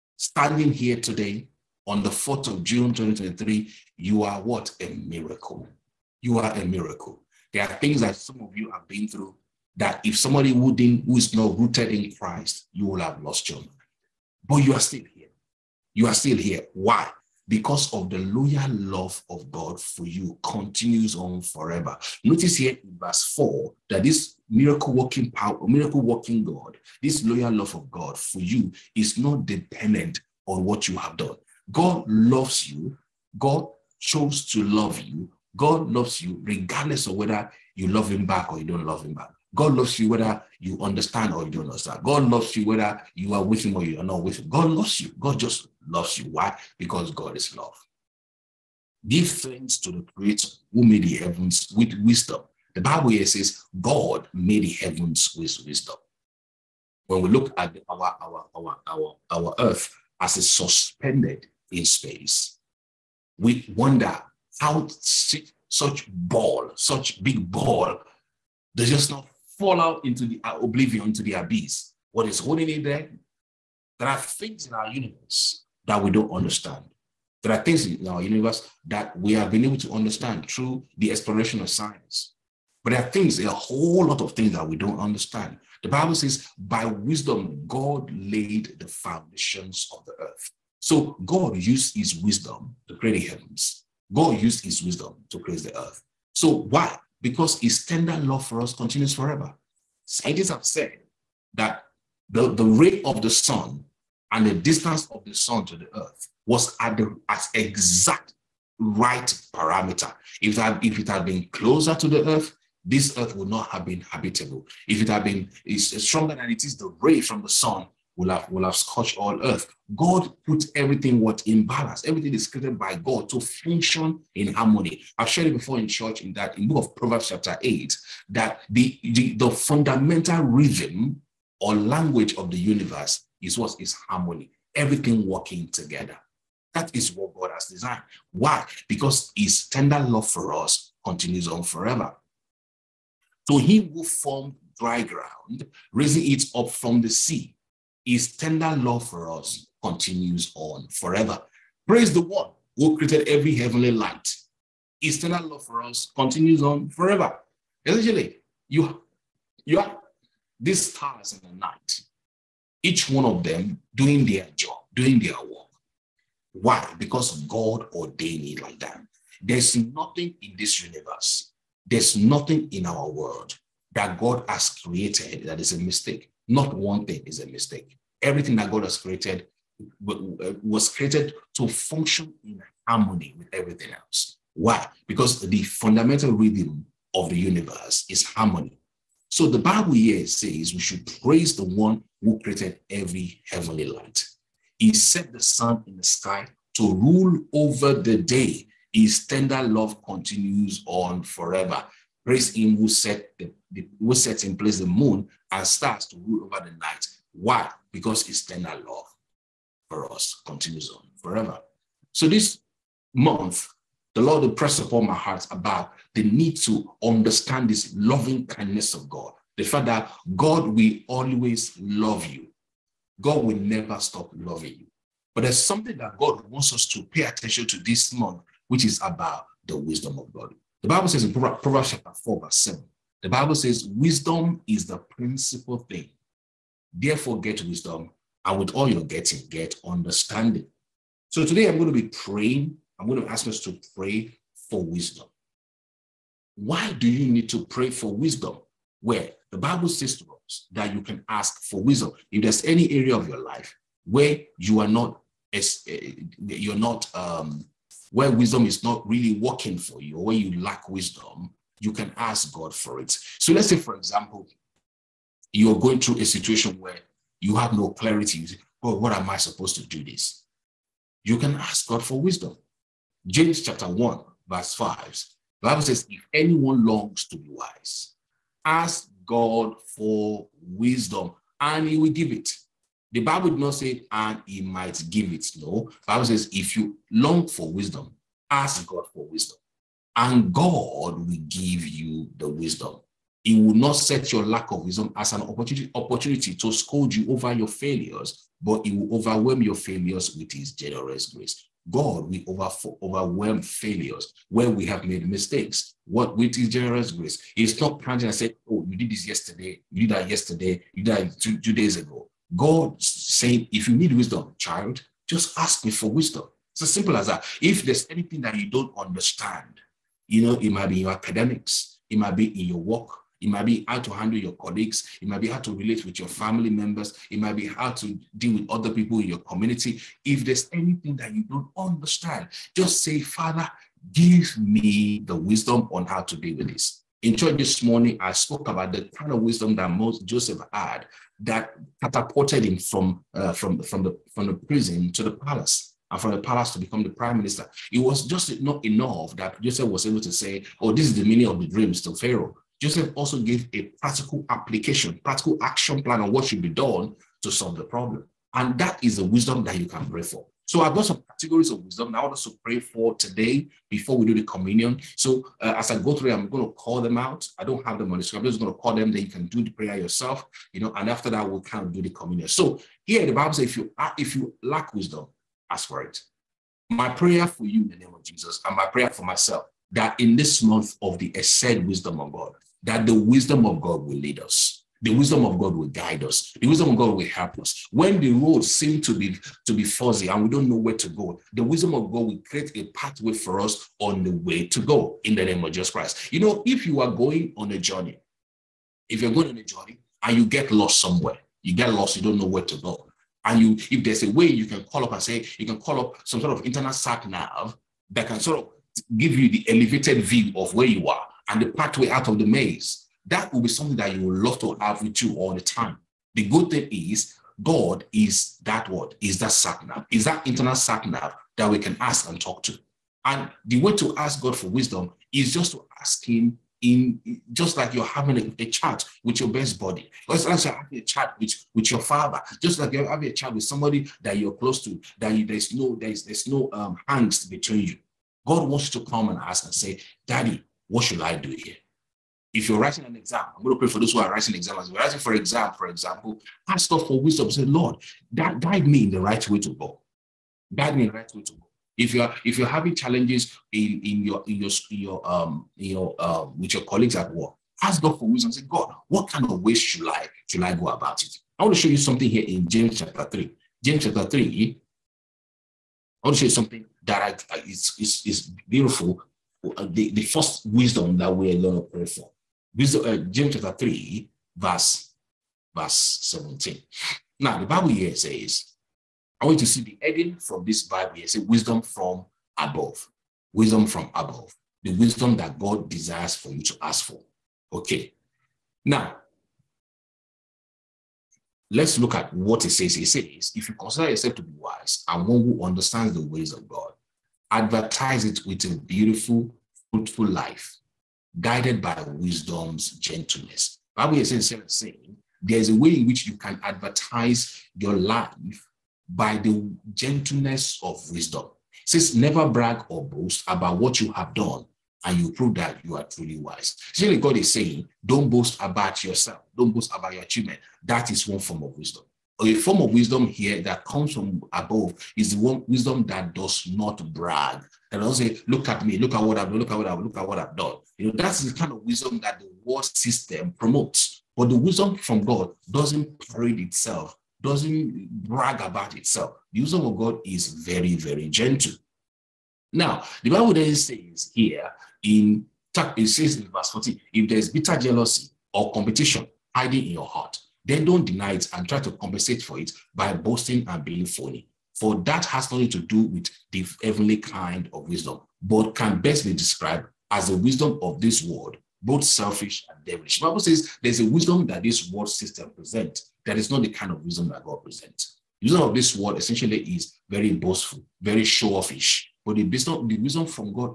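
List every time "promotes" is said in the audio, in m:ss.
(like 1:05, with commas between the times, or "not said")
8:53.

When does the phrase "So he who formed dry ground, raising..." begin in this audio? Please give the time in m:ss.
2:23.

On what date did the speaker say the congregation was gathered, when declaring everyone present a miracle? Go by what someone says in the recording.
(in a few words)
4 June 2023.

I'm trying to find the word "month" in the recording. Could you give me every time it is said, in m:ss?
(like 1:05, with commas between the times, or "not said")
3:33, 3:48, 6:20.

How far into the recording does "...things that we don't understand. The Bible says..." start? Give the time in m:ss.
1:24.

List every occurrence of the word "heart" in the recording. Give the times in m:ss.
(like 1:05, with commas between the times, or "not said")
3:35, 9:10.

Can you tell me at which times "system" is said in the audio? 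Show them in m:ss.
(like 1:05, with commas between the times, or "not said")
8:52, 9:25.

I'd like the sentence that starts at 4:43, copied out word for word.
The Bible did not say, and he might give it.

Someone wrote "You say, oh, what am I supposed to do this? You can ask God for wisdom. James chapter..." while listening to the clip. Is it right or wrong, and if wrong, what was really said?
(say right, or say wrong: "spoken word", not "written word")
right.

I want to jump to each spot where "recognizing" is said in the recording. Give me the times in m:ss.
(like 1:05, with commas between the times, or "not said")
not said.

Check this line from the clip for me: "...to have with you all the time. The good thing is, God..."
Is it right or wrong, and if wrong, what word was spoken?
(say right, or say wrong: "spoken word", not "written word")
right.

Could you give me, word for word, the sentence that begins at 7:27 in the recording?
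Say, Lord, guide me in the right way to go.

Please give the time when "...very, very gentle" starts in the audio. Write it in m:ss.
9:00.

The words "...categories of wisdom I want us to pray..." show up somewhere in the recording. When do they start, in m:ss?
6:01.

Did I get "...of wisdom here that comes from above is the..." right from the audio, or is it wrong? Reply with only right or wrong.
right.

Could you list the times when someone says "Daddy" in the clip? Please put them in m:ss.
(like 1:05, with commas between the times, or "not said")
7:20.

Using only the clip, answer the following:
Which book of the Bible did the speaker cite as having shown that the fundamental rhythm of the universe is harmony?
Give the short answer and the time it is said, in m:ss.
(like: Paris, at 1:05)
Proverbs chapter 8, at 2:06.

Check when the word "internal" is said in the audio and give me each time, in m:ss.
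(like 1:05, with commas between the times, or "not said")
6:46, 7:00.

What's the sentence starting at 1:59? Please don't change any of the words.
God put everything what in balance.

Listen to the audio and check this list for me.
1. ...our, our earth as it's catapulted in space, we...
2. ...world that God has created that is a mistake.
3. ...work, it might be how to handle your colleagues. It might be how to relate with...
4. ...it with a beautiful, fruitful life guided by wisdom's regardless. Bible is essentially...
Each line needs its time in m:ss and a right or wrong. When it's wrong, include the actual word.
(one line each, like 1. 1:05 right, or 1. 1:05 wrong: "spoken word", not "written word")
1. 0:58 wrong: "suspended", not "catapulted"
2. 2:53 right
3. 5:22 right
4. 8:18 wrong: "gentleness", not "regardless".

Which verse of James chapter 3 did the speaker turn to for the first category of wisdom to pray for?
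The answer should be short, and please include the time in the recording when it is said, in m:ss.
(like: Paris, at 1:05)
Verse 17, at 7:55.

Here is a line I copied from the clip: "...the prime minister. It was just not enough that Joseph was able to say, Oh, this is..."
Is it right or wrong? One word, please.
right.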